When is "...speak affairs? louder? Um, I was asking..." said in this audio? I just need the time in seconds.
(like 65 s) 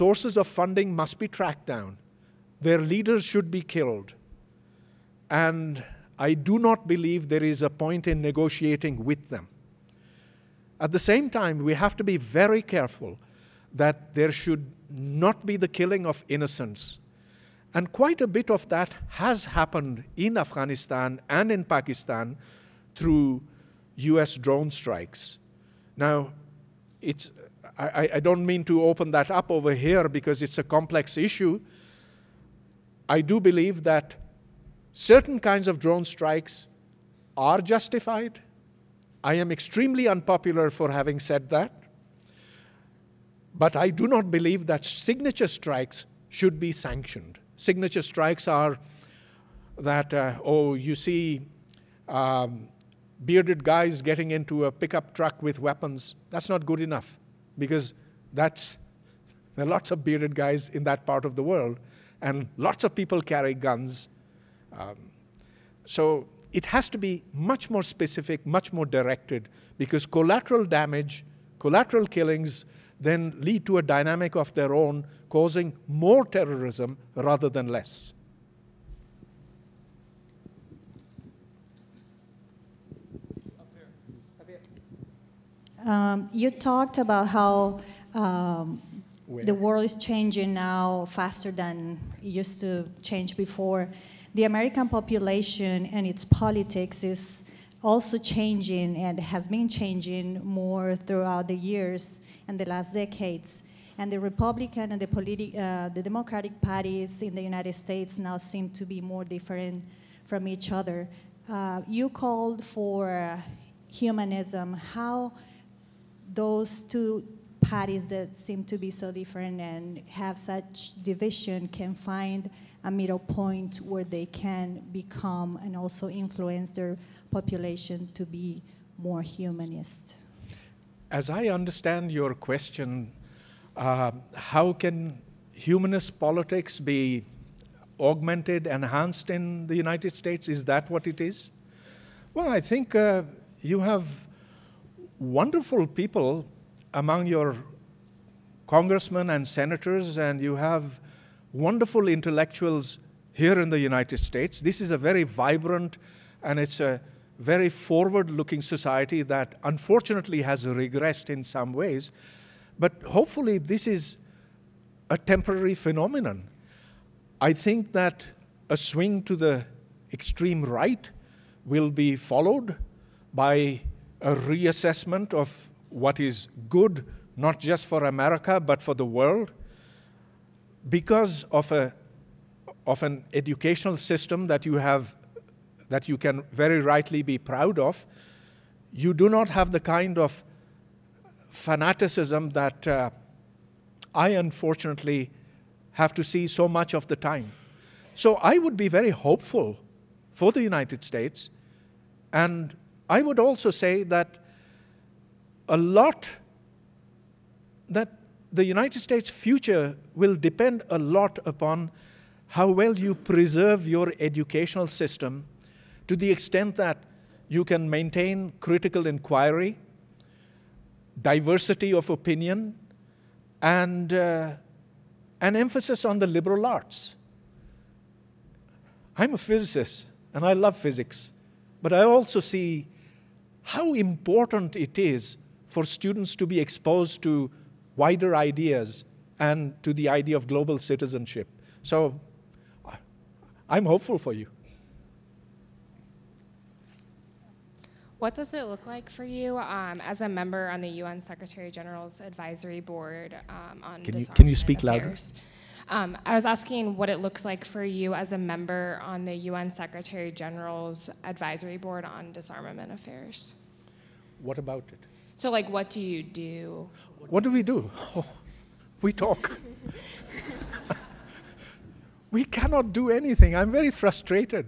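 254 s.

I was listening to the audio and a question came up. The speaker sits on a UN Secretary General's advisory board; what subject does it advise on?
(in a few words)
Disarmament Affairs.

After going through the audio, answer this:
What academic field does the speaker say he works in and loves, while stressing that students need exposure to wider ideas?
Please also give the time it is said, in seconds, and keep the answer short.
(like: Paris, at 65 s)
Physics, at 229 s.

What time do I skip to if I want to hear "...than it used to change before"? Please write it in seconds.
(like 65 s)
91 s.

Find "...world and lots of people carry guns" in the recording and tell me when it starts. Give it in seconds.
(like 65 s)
61 s.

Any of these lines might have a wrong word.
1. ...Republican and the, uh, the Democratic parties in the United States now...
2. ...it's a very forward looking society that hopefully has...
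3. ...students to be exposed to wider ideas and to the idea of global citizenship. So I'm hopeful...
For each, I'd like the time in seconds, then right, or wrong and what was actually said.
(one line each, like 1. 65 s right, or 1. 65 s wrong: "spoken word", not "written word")
1. 104 s right
2. 156 s wrong: "unfortunately", not "hopefully"
3. 235 s right.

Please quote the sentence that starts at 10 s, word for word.
At the same time, we have to be very careful that there should not be the killing of innocents.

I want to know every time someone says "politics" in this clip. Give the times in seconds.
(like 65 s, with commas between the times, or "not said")
96 s, 136 s.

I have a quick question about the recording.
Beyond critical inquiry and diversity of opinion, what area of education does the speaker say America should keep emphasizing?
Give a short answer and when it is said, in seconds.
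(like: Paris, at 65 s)
The liberal arts, at 226 s.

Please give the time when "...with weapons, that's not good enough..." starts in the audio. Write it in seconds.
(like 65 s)
55 s.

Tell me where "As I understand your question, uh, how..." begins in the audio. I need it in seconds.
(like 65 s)
131 s.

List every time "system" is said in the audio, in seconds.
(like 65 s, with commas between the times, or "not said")
183 s, 214 s.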